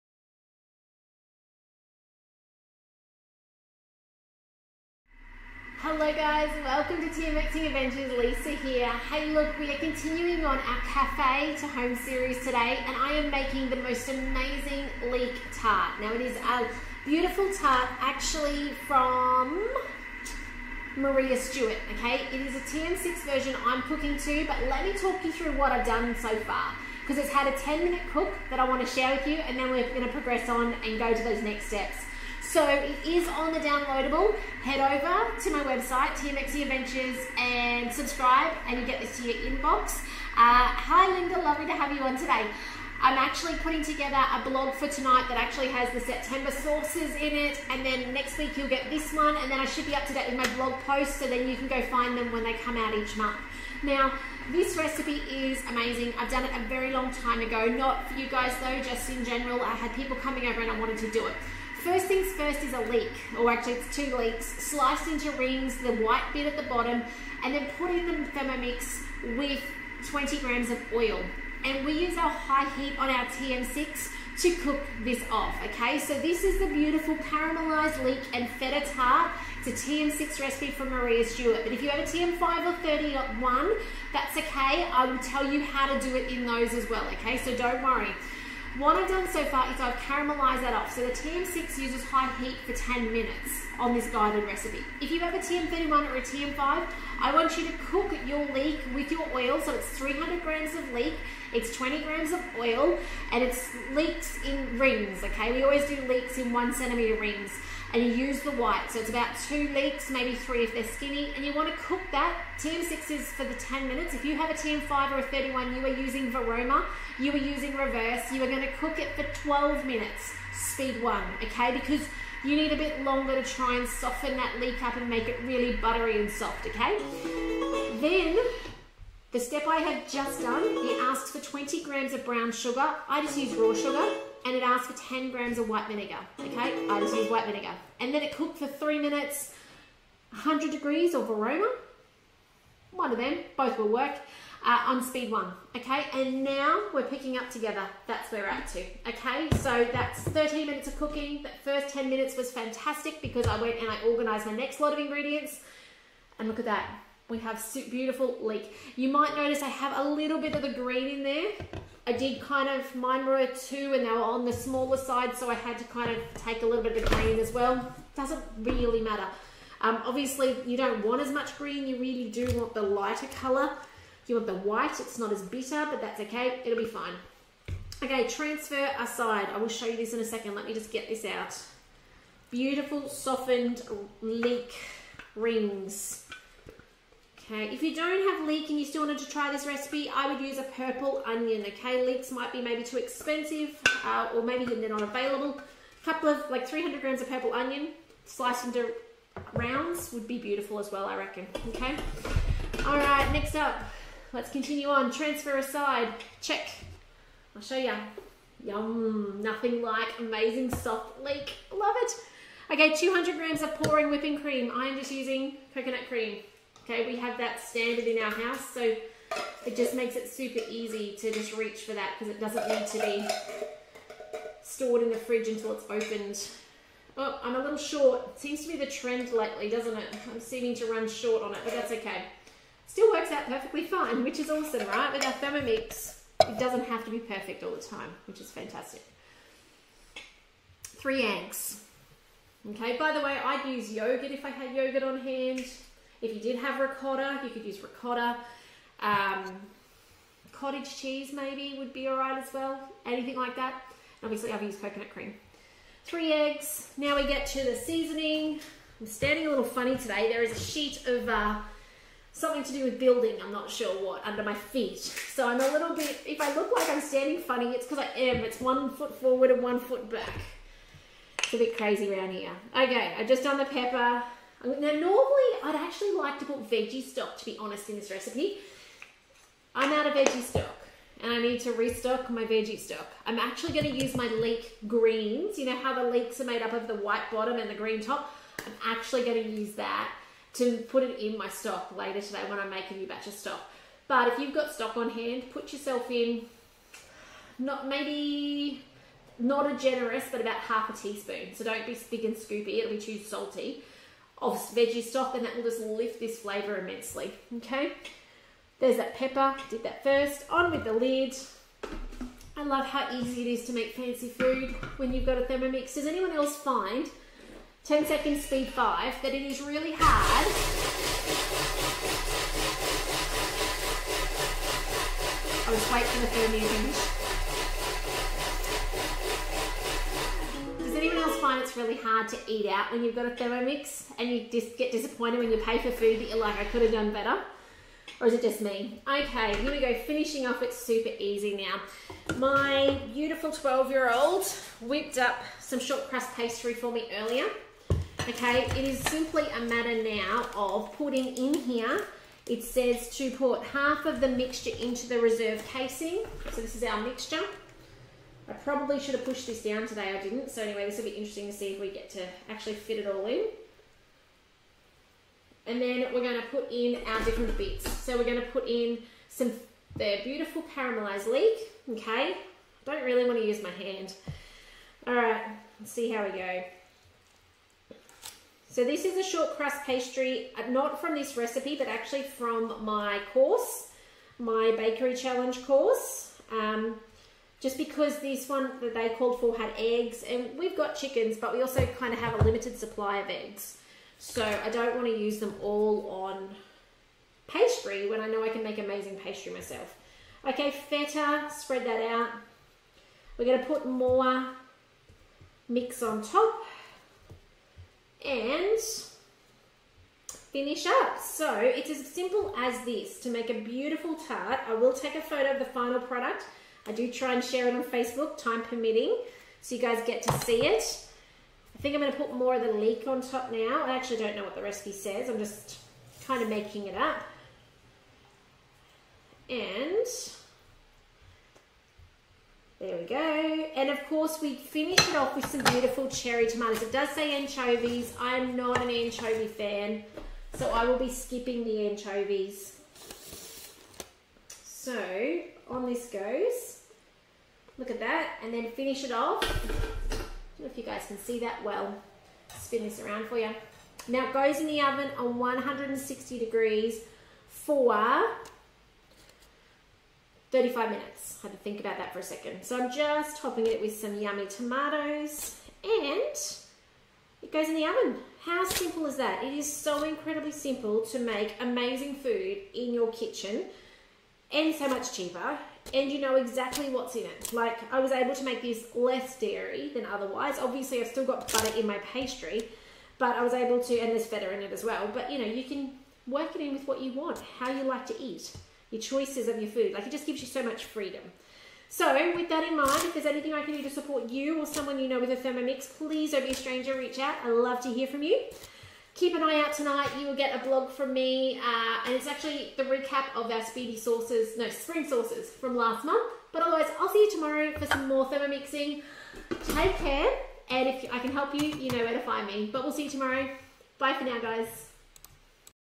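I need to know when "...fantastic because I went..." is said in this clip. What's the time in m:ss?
2:32.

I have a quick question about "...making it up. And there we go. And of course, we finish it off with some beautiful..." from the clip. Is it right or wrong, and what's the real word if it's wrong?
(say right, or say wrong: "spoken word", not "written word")
right.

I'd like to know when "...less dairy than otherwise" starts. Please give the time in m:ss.
7:58.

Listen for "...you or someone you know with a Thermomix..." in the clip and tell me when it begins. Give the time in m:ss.
8:14.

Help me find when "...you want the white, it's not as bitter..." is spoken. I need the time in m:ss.
2:54.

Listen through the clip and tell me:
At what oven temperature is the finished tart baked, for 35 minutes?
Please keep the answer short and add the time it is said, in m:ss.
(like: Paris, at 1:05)
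160 degrees, at 7:35.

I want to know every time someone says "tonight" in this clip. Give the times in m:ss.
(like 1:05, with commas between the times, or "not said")
0:44, 8:19.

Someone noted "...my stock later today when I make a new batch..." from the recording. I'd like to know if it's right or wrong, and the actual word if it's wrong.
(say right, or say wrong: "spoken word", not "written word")
right.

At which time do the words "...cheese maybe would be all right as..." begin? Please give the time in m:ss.
4:10.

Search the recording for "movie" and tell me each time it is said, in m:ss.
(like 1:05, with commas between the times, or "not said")
not said.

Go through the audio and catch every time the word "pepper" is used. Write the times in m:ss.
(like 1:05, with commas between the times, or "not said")
4:33, 5:09.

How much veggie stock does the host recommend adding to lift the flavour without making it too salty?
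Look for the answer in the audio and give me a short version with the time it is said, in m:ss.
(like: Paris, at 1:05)
half a teaspoon, at 5:00.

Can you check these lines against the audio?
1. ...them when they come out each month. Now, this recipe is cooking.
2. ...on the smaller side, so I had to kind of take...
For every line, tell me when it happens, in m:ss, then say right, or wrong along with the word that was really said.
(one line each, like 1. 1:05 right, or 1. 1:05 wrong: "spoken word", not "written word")
1. 0:52 wrong: "amazing", not "cooking"
2. 2:44 right.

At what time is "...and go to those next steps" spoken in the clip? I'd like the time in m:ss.
0:30.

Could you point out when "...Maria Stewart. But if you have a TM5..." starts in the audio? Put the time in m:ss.
1:20.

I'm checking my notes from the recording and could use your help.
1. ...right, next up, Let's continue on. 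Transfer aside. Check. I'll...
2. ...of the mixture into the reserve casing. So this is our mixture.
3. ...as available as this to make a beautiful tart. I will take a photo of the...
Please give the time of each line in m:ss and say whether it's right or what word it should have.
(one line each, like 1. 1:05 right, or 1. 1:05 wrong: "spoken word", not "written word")
1. 3:22 right
2. 5:54 right
3. 6:51 wrong: "simple", not "available".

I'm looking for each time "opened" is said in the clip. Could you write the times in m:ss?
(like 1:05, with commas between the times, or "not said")
3:45.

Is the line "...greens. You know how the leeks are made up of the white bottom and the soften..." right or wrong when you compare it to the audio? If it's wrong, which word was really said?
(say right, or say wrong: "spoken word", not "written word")
wrong: "green", not "soften".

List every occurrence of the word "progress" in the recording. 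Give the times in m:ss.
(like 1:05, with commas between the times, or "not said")
0:30.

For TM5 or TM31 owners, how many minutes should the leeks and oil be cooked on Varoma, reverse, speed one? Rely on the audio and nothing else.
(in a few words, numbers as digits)
12 minutes.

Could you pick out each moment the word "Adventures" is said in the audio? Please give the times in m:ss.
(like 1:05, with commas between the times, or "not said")
0:07, 0:36.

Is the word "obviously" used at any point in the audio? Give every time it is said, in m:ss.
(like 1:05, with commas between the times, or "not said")
2:50, 4:14, 8:00.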